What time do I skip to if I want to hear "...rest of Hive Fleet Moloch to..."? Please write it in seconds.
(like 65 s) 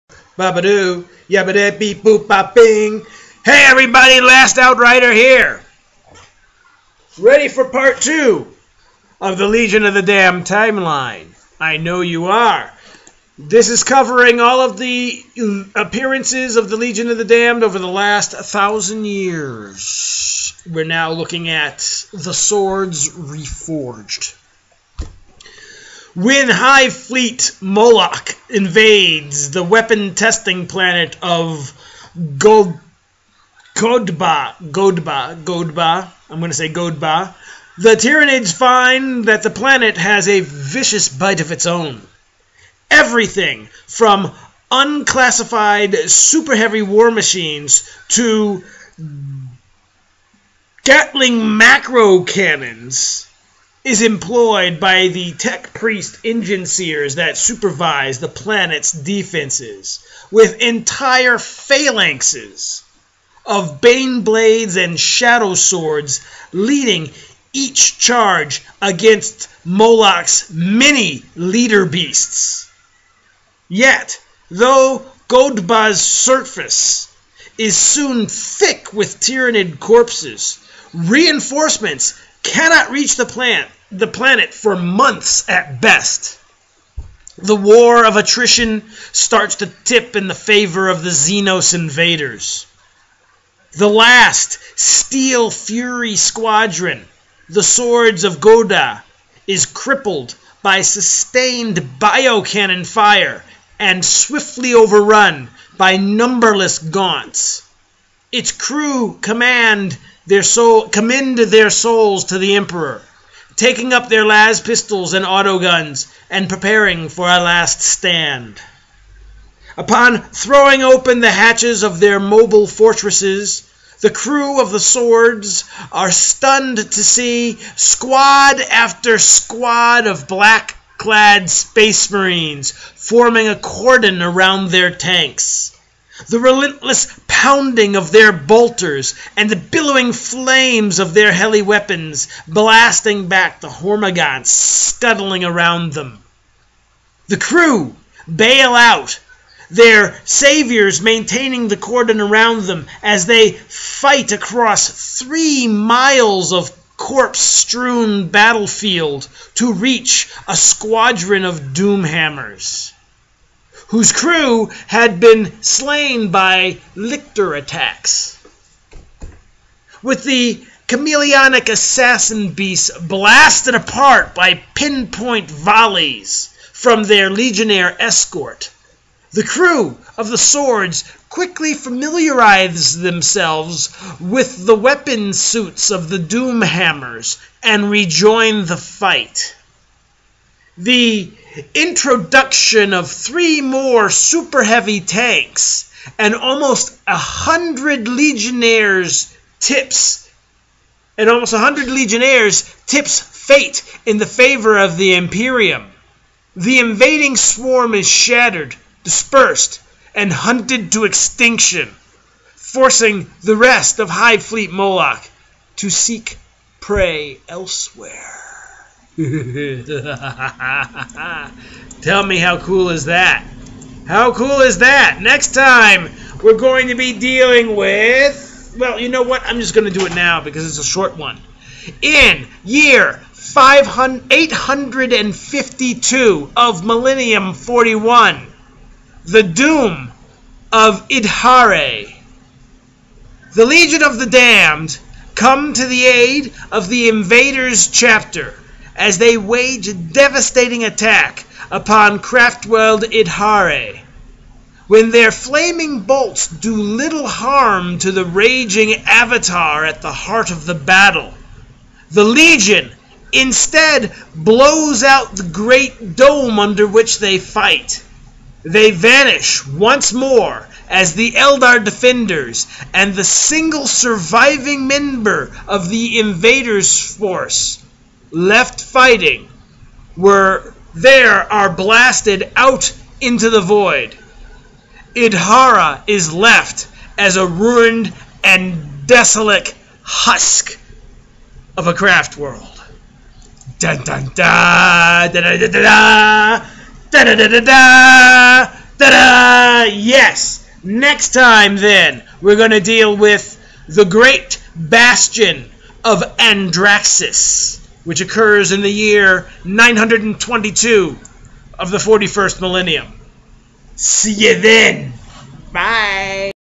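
213 s.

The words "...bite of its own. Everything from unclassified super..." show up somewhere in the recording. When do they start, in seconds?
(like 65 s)
41 s.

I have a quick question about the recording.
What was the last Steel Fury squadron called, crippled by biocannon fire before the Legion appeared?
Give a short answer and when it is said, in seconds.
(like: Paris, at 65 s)
Swords of Goda, at 97 s.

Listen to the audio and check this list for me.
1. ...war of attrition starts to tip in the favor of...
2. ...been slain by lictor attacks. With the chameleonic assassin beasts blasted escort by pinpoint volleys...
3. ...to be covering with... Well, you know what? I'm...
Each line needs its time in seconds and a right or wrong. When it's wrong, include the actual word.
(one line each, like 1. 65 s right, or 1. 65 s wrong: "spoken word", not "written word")
1. 87 s right
2. 165 s wrong: "apart", not "escort"
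3. 226 s wrong: "dealing", not "covering".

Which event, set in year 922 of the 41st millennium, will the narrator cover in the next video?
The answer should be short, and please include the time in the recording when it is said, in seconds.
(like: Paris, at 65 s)
Great bastion of Andraxis, at 303 s.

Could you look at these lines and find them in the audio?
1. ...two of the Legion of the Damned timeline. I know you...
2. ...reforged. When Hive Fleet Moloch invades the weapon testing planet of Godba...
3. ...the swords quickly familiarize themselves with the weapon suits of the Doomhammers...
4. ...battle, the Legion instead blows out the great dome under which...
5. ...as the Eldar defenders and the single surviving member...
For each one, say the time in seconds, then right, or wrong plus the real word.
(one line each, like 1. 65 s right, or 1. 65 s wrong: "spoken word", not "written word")
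1. 8 s right
2. 23 s right
3. 180 s right
4. 260 s right
5. 270 s right.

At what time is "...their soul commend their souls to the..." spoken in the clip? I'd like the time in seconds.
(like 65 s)
110 s.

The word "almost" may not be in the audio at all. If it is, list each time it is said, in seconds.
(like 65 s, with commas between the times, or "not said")
196 s, 201 s.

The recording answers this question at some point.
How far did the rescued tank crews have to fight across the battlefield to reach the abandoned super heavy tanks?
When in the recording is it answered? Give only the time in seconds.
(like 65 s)
155 s.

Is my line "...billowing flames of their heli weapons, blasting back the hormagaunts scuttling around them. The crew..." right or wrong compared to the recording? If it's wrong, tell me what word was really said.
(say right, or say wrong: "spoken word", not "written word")
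right.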